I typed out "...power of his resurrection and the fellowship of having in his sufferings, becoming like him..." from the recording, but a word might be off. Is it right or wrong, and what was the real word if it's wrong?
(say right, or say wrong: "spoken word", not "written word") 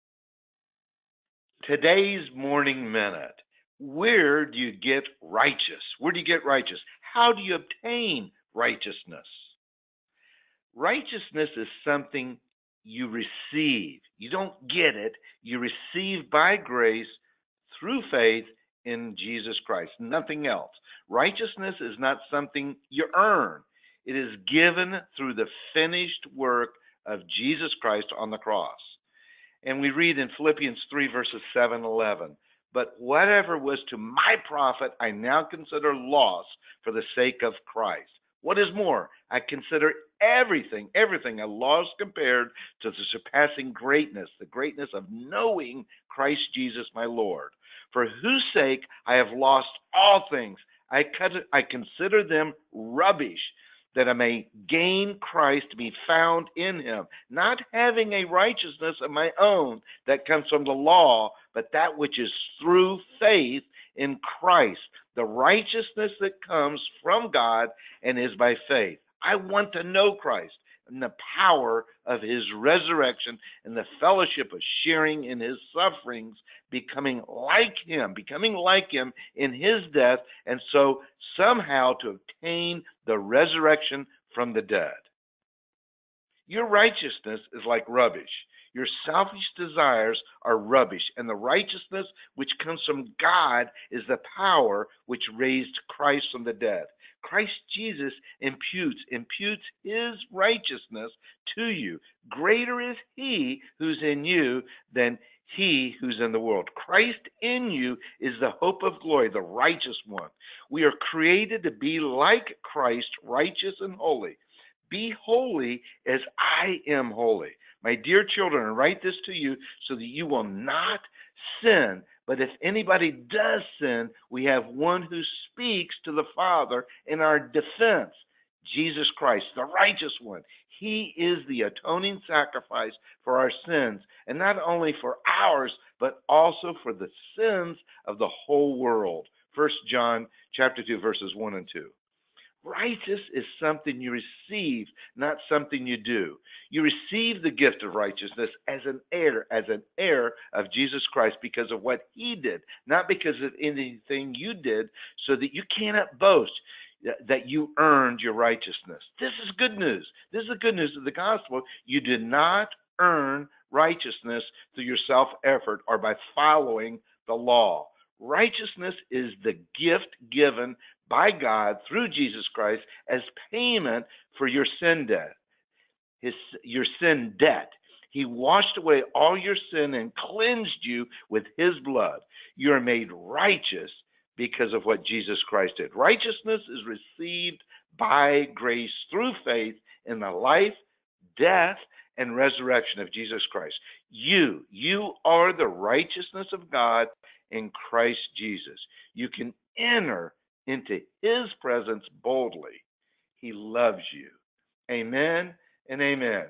wrong: "sharing", not "having".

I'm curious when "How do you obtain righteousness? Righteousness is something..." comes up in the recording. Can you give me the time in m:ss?
0:07.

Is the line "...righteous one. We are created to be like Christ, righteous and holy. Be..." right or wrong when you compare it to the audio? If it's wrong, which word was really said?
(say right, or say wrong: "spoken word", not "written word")
right.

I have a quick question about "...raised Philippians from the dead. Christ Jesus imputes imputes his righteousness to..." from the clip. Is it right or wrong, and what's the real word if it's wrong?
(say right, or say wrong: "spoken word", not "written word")
wrong: "Christ", not "Philippians".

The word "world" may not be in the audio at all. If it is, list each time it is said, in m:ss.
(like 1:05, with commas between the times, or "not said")
1:46, 2:18.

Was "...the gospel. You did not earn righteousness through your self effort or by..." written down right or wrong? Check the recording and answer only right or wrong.
right.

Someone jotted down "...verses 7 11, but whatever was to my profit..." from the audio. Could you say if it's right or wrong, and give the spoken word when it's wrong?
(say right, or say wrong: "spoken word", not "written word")
right.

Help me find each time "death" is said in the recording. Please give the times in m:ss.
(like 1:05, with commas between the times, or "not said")
1:19, 3:11.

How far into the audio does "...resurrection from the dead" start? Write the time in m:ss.
1:23.